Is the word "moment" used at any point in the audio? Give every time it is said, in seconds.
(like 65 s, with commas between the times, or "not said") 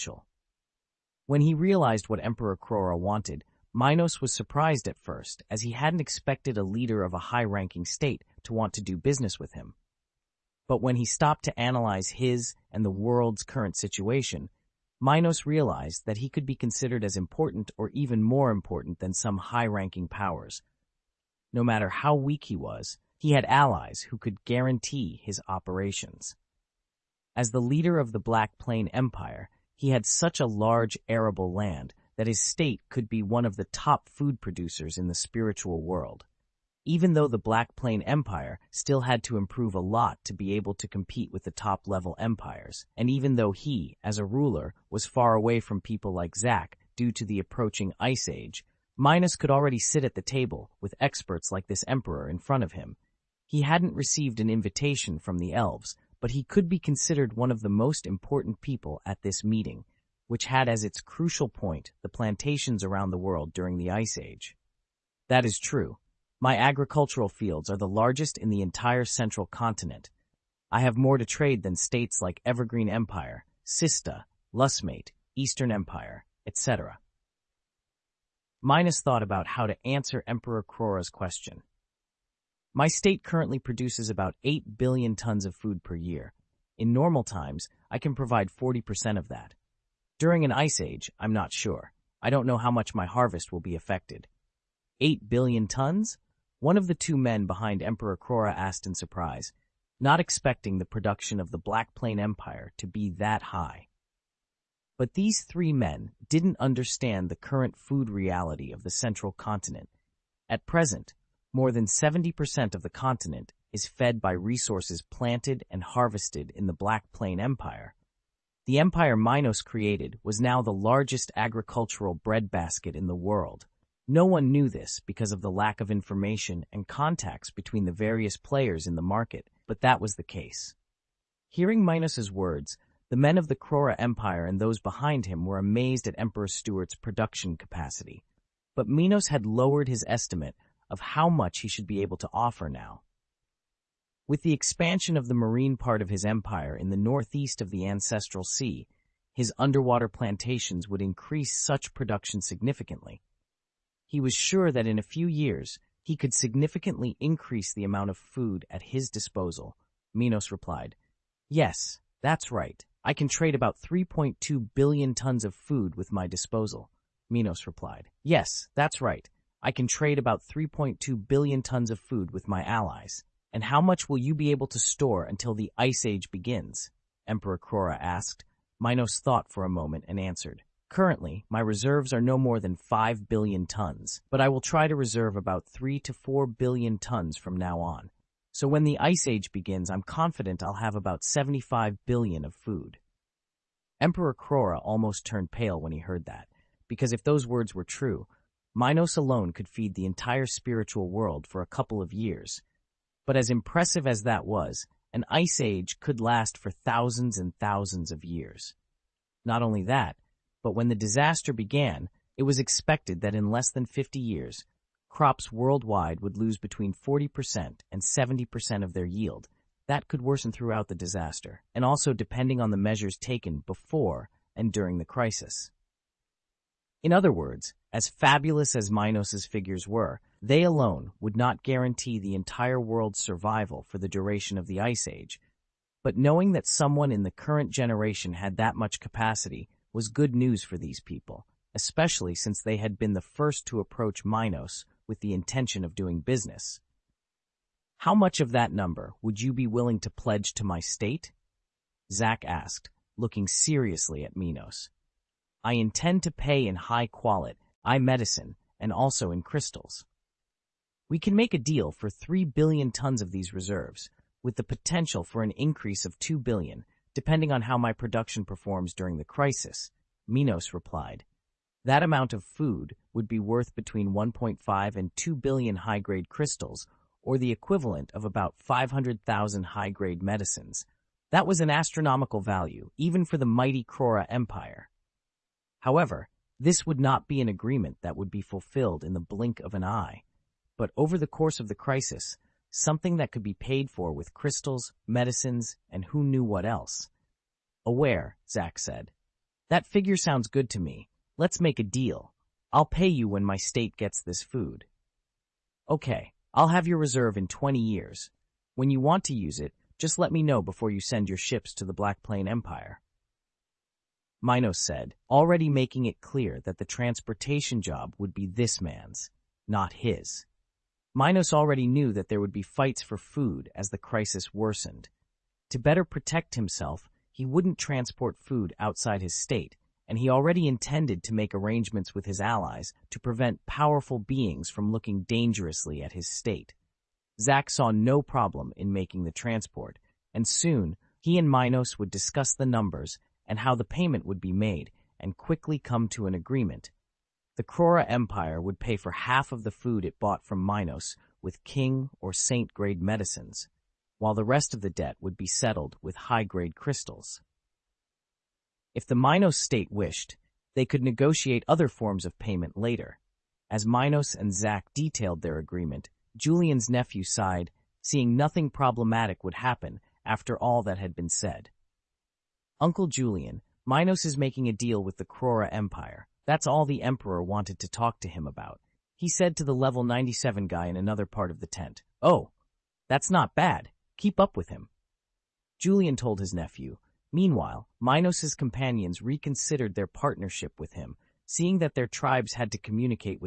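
179 s.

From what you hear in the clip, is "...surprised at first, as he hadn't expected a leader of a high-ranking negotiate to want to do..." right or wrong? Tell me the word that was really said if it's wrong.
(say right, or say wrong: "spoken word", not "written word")
wrong: "state", not "negotiate".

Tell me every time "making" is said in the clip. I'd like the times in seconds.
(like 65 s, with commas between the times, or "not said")
315 s, 338 s, 374 s.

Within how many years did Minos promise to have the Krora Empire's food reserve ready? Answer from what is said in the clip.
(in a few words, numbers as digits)
20 years.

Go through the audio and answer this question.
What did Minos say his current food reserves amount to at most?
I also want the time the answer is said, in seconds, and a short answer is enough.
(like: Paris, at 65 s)
5 billion tons, at 182 s.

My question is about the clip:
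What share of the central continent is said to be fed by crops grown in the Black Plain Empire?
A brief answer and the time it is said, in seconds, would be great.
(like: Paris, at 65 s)
more than 70%, at 111 s.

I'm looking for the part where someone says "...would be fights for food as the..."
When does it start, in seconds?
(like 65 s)
322 s.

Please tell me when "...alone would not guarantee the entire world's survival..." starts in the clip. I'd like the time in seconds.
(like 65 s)
230 s.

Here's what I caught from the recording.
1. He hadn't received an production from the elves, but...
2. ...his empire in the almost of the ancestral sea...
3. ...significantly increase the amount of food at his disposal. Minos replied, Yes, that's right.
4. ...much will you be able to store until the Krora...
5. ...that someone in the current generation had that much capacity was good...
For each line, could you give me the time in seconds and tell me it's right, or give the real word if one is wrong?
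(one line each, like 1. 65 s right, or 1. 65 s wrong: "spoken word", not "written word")
1. 53 s wrong: "invitation", not "production"
2. 146 s wrong: "northeast", not "almost"
3. 156 s right
4. 173 s wrong: "Ice", not "Krora"
5. 236 s right.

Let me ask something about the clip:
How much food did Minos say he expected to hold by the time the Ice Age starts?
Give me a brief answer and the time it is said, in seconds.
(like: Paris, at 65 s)
75 billion, at 191 s.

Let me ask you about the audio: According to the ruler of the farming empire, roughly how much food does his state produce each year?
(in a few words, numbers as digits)
8 billion tons.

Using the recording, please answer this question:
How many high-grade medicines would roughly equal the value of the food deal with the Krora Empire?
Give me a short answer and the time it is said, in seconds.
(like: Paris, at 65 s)
500,000, at 278 s.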